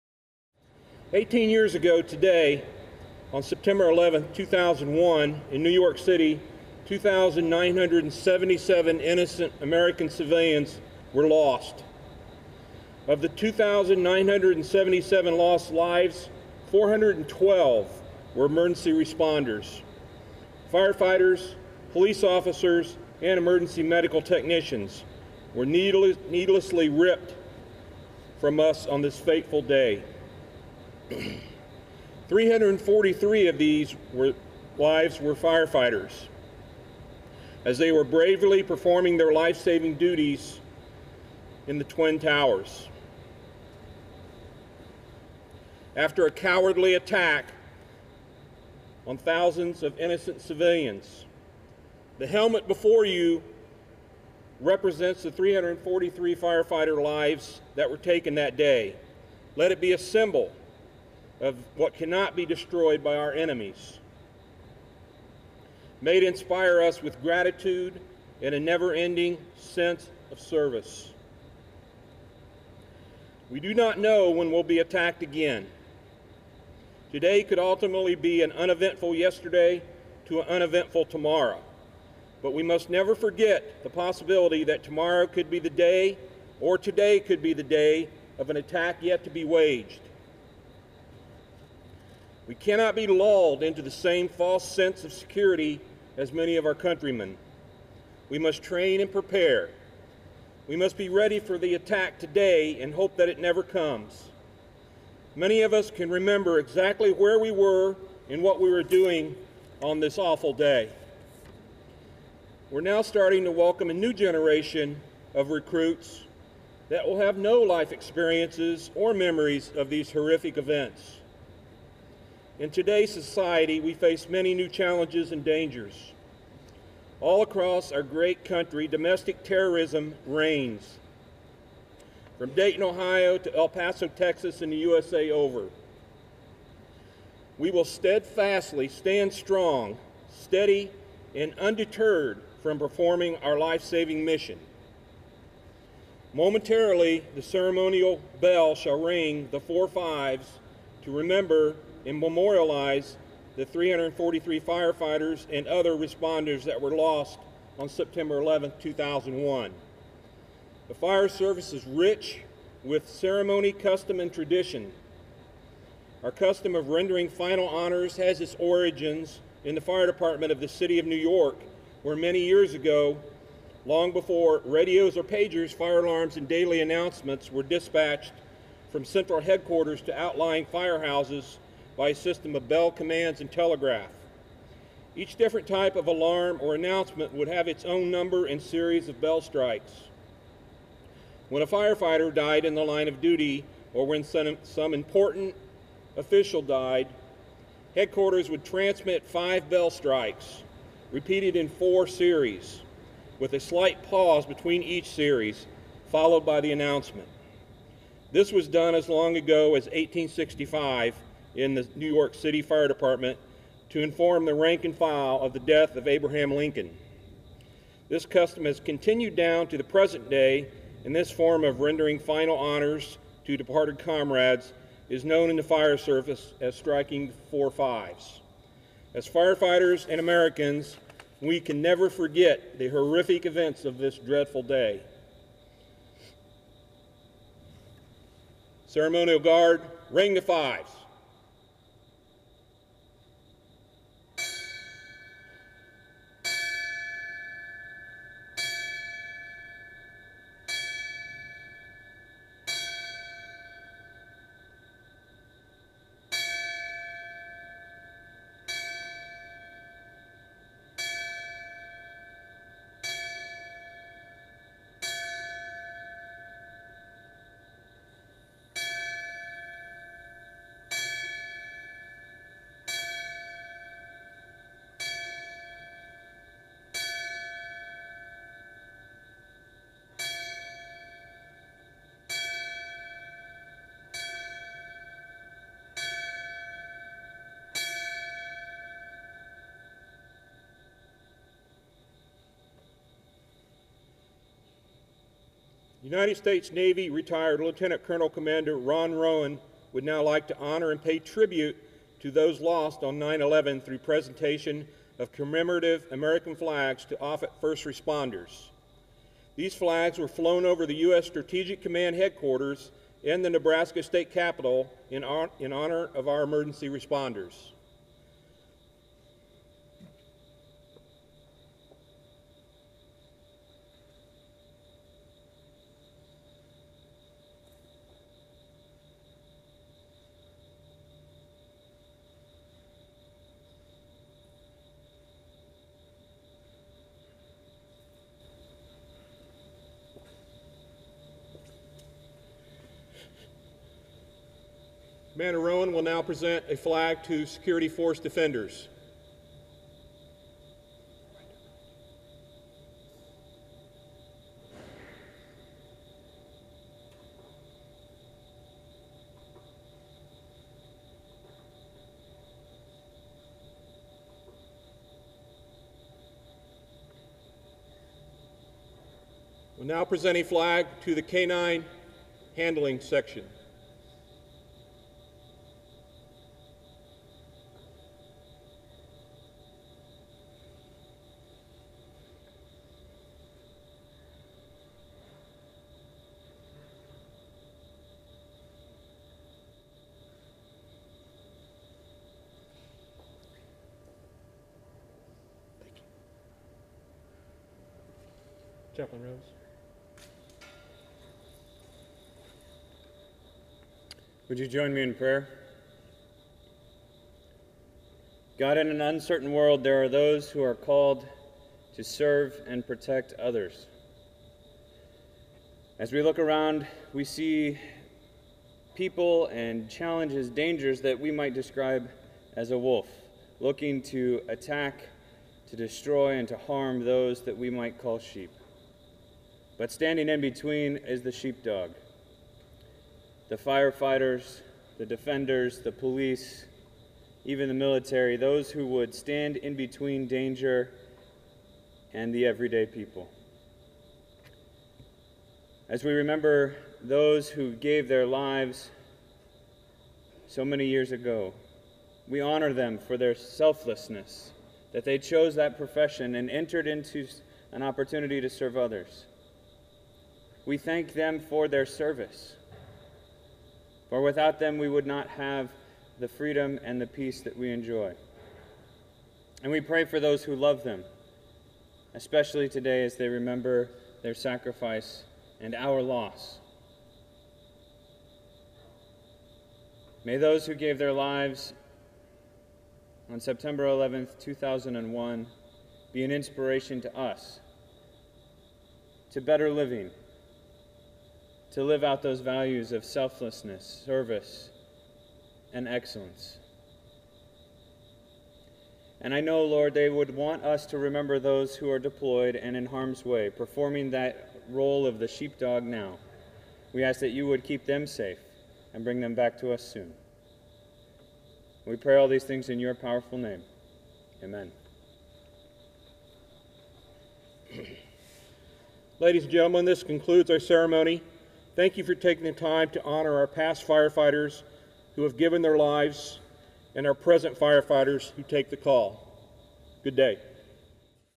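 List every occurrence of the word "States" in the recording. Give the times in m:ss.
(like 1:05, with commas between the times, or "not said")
4:56, 5:14.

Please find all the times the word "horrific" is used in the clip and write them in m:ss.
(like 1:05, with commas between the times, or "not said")
2:00, 3:52.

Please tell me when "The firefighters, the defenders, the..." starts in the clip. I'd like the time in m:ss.
7:13.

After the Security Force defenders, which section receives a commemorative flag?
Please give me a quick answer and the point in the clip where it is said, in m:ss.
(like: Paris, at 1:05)
K-9 Handling Section, at 6:11.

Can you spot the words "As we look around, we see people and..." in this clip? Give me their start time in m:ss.
6:55.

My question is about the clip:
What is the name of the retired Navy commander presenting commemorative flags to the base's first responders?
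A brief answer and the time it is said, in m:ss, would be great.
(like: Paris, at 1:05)
Ron Rowan, at 4:58.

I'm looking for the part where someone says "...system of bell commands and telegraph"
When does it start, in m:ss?
3:02.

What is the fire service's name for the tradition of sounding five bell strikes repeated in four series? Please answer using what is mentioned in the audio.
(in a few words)
striking four fives.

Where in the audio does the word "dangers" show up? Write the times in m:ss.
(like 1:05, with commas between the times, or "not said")
2:05, 7:00, 7:20.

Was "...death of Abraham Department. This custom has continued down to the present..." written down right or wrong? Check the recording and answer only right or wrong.
wrong.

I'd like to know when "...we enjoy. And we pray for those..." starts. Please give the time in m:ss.
7:47.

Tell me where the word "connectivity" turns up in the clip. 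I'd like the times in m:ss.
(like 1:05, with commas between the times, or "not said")
not said.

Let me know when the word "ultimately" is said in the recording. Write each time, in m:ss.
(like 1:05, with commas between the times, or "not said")
1:17.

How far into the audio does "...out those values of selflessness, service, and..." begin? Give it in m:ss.
8:12.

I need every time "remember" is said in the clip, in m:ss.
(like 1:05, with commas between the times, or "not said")
1:46, 2:31, 7:26, 7:53, 8:20.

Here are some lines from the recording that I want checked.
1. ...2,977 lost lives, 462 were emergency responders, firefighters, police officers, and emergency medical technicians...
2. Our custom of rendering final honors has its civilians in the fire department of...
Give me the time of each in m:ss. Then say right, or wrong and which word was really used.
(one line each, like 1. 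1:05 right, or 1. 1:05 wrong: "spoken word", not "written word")
1. 0:13 wrong: "412", not "462"
2. 2:46 wrong: "origins", not "civilians".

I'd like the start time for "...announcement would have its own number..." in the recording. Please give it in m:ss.
3:06.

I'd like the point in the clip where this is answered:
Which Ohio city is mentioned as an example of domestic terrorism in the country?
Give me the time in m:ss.
2:12.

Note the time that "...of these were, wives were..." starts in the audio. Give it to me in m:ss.
0:33.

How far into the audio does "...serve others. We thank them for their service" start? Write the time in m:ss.
7:38.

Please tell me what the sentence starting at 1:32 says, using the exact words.
We cannot be lulled into the same false sense of security as many of our countrymen.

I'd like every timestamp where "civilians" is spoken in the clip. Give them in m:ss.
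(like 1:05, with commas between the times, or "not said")
0:10, 0:50.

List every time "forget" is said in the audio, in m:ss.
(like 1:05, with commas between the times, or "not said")
1:23, 3:52.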